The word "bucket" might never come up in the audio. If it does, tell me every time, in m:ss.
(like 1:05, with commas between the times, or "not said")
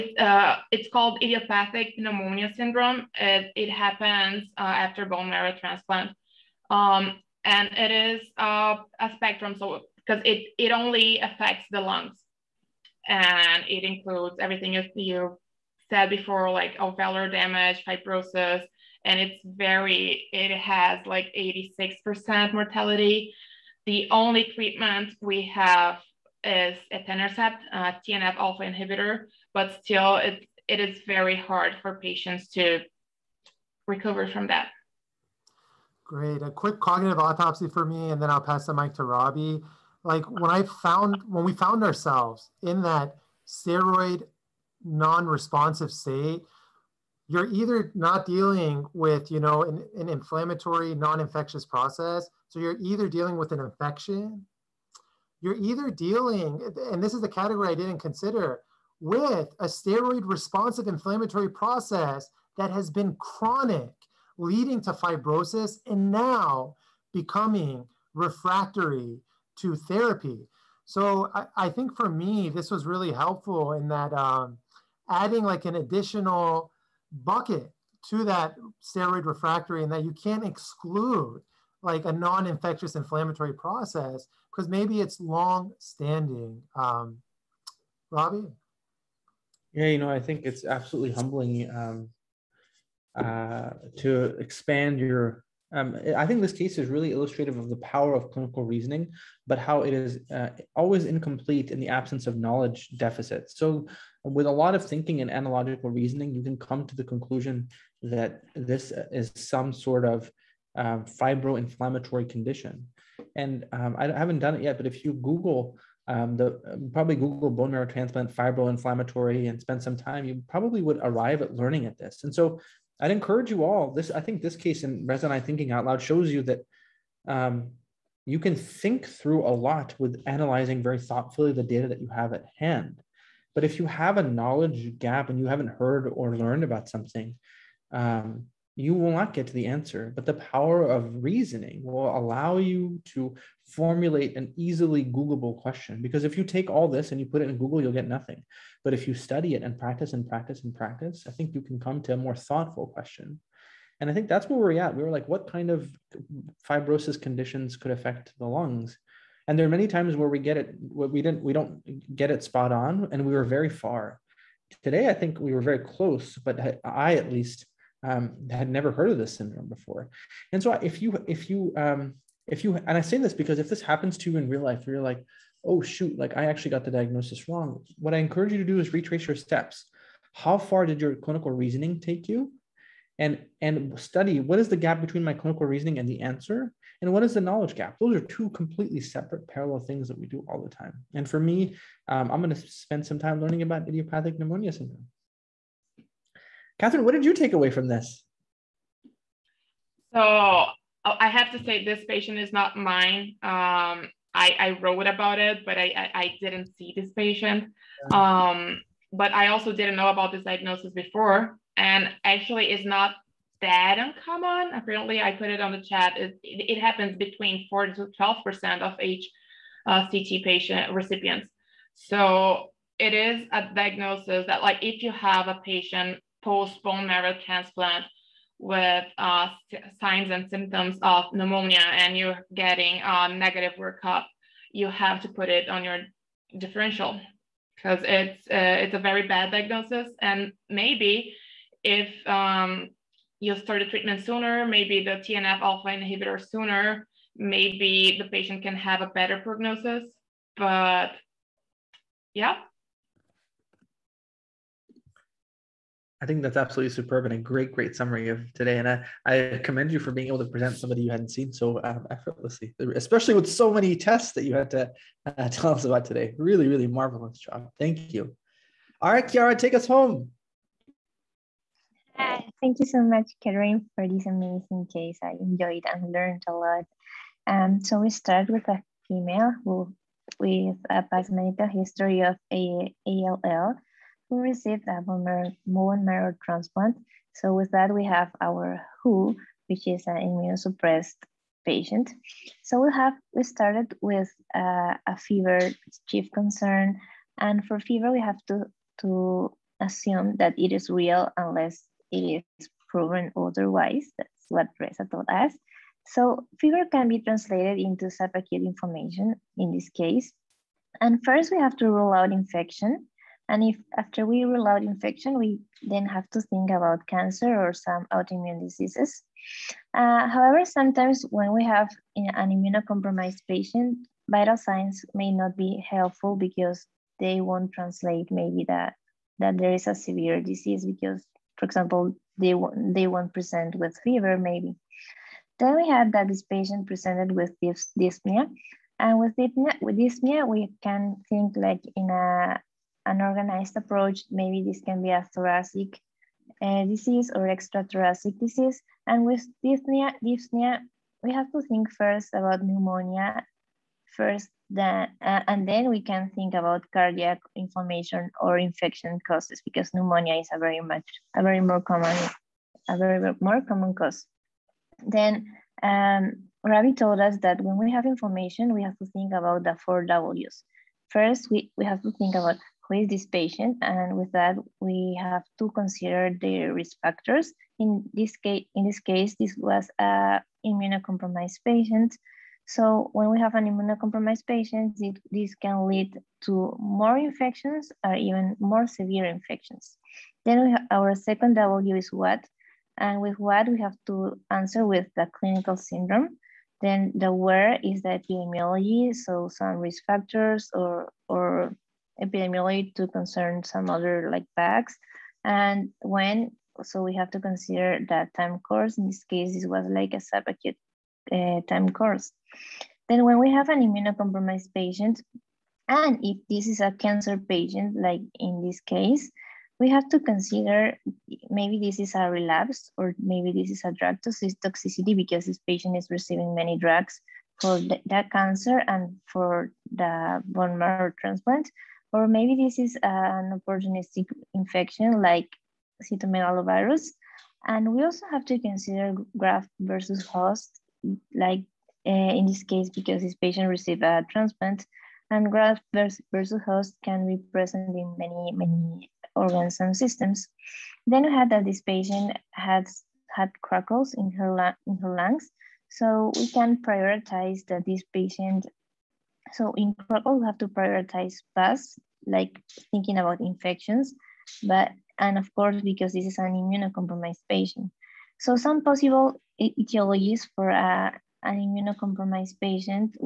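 1:17.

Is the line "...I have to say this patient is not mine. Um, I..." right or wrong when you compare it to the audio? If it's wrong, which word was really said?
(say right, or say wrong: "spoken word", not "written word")
right.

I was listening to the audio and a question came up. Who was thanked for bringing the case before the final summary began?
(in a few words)
Karim.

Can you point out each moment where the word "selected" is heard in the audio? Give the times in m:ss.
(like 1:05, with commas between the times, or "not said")
not said.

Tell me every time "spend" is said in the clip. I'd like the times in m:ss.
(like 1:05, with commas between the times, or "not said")
1:59, 3:12.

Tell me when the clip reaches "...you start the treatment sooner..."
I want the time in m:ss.
4:03.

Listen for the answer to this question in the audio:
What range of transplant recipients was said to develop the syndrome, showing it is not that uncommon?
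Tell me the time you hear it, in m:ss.
3:37.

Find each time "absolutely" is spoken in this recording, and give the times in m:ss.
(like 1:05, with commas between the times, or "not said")
1:30, 4:16.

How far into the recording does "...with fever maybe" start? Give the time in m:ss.
5:33.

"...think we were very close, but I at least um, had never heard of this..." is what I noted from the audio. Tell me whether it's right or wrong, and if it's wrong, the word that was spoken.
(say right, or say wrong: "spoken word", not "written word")
right.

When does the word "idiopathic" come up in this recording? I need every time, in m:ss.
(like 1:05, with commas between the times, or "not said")
0:01, 3:13.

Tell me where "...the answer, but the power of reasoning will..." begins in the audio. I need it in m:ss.
2:19.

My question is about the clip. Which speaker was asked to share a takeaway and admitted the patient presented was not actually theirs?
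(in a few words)
Catherine.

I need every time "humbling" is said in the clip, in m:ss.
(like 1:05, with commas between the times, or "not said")
1:31.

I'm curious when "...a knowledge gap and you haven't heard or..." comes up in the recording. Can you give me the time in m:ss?
2:14.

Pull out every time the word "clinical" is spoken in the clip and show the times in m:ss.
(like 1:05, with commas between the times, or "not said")
1:38, 3:01, 3:05, 6:35.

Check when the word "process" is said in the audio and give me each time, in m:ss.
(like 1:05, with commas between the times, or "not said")
0:51, 1:01, 1:23.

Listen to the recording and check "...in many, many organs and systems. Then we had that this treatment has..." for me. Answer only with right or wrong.
wrong.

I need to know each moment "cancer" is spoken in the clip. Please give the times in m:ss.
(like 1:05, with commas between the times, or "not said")
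5:17, 6:56, 7:08.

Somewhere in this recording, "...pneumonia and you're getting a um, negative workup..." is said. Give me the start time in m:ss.
3:51.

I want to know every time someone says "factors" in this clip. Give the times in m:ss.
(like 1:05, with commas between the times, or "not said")
6:17, 6:40.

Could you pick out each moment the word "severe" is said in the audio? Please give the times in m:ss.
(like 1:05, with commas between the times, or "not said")
5:29, 6:28.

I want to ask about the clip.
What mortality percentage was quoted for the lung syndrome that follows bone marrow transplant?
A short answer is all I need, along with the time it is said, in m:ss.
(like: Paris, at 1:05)
86%, at 0:21.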